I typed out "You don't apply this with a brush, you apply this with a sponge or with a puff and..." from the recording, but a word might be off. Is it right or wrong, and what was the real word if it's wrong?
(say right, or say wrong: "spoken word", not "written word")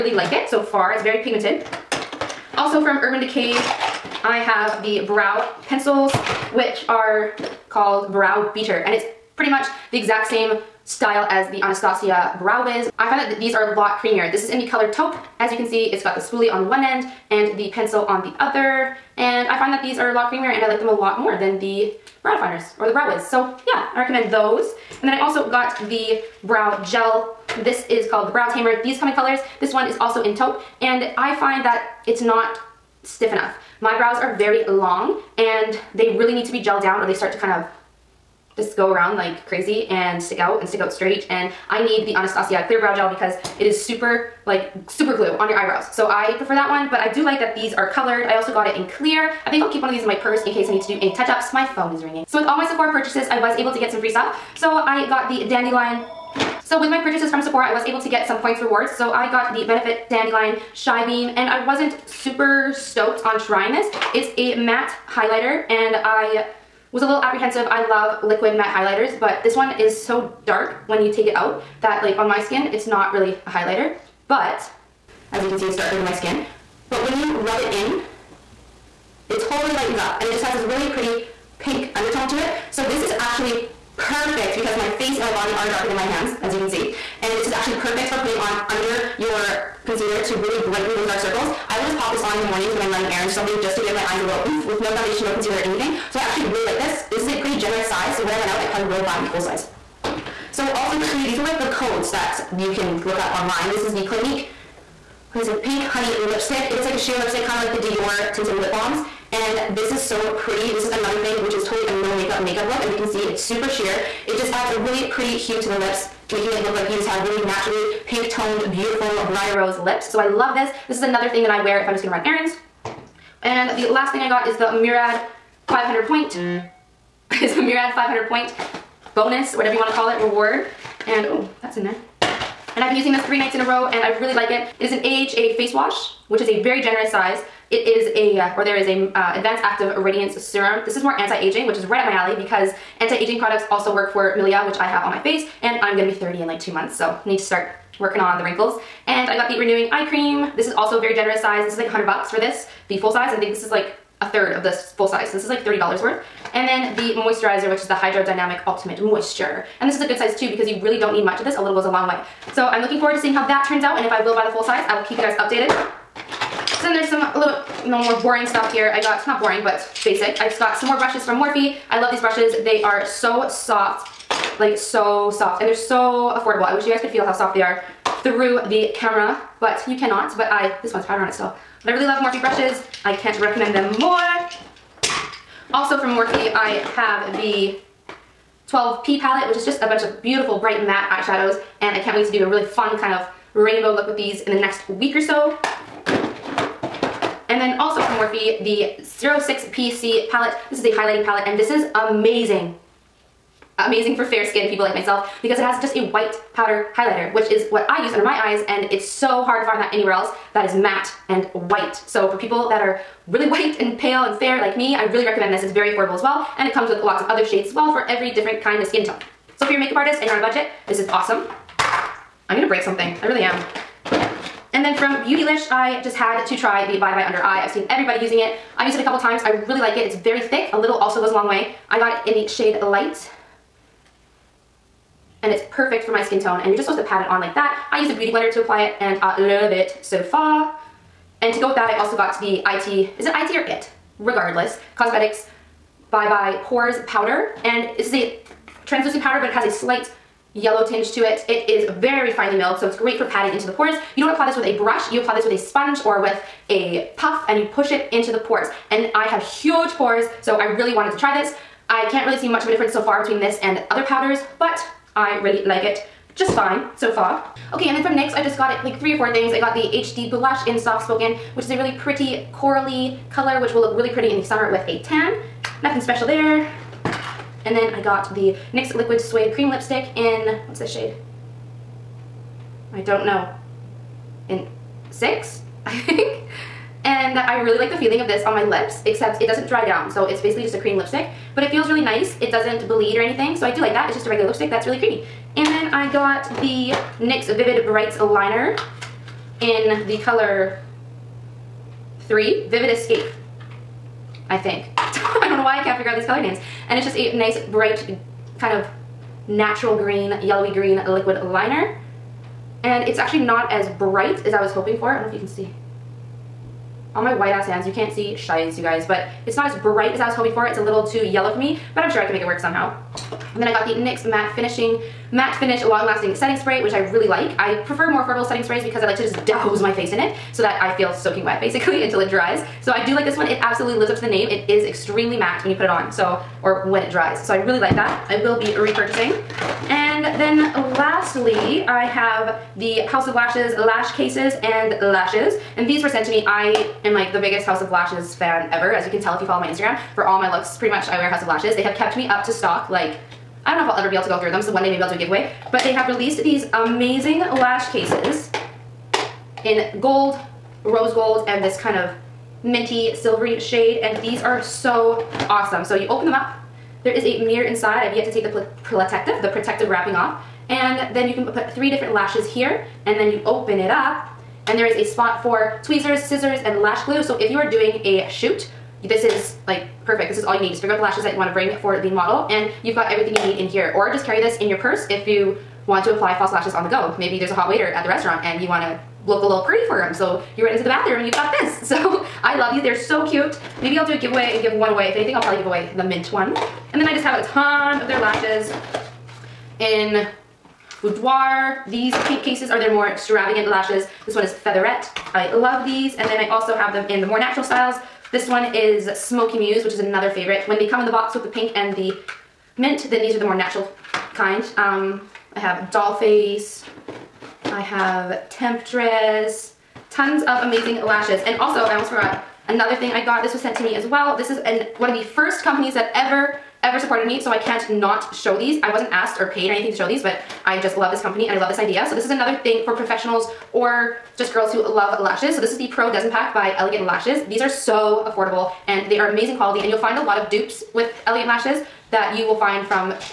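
right.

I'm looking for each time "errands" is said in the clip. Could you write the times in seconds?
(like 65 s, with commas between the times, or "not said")
93 s, 122 s.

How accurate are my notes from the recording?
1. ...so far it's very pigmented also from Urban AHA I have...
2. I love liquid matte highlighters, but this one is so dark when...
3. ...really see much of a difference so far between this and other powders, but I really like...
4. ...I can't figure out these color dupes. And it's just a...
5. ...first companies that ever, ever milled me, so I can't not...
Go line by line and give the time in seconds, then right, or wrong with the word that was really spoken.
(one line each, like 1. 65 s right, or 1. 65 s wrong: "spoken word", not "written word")
1. 0 s wrong: "Decay", not "AHA"
2. 67 s right
3. 262 s right
4. 305 s wrong: "names", not "dupes"
5. 425 s wrong: "supported", not "milled".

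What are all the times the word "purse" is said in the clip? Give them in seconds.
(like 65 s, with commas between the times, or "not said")
50 s, 384 s.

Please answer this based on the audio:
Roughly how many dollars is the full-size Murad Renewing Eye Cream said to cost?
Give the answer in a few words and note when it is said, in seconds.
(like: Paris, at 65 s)
100, at 151 s.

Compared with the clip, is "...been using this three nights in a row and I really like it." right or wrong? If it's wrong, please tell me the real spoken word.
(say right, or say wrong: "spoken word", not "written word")
right.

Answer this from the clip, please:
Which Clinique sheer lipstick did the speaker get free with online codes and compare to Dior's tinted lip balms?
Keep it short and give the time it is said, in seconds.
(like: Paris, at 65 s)
Pink Honey, at 105 s.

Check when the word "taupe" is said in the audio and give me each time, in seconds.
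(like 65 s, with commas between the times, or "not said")
14 s, 30 s.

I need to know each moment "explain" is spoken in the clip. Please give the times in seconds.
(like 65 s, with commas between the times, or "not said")
not said.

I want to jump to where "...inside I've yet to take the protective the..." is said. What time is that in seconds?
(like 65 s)
367 s.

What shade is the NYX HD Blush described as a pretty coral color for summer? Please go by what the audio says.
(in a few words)
Soft Spoken.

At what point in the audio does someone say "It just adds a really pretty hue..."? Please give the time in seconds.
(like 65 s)
114 s.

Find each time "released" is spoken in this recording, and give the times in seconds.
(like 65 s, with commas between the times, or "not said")
356 s.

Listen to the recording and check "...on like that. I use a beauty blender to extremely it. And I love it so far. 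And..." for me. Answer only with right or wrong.
wrong.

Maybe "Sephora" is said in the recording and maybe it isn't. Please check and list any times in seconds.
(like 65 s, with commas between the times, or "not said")
52 s, 57 s.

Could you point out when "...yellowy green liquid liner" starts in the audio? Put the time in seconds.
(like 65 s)
310 s.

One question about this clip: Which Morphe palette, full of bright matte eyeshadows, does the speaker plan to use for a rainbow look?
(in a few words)
12P.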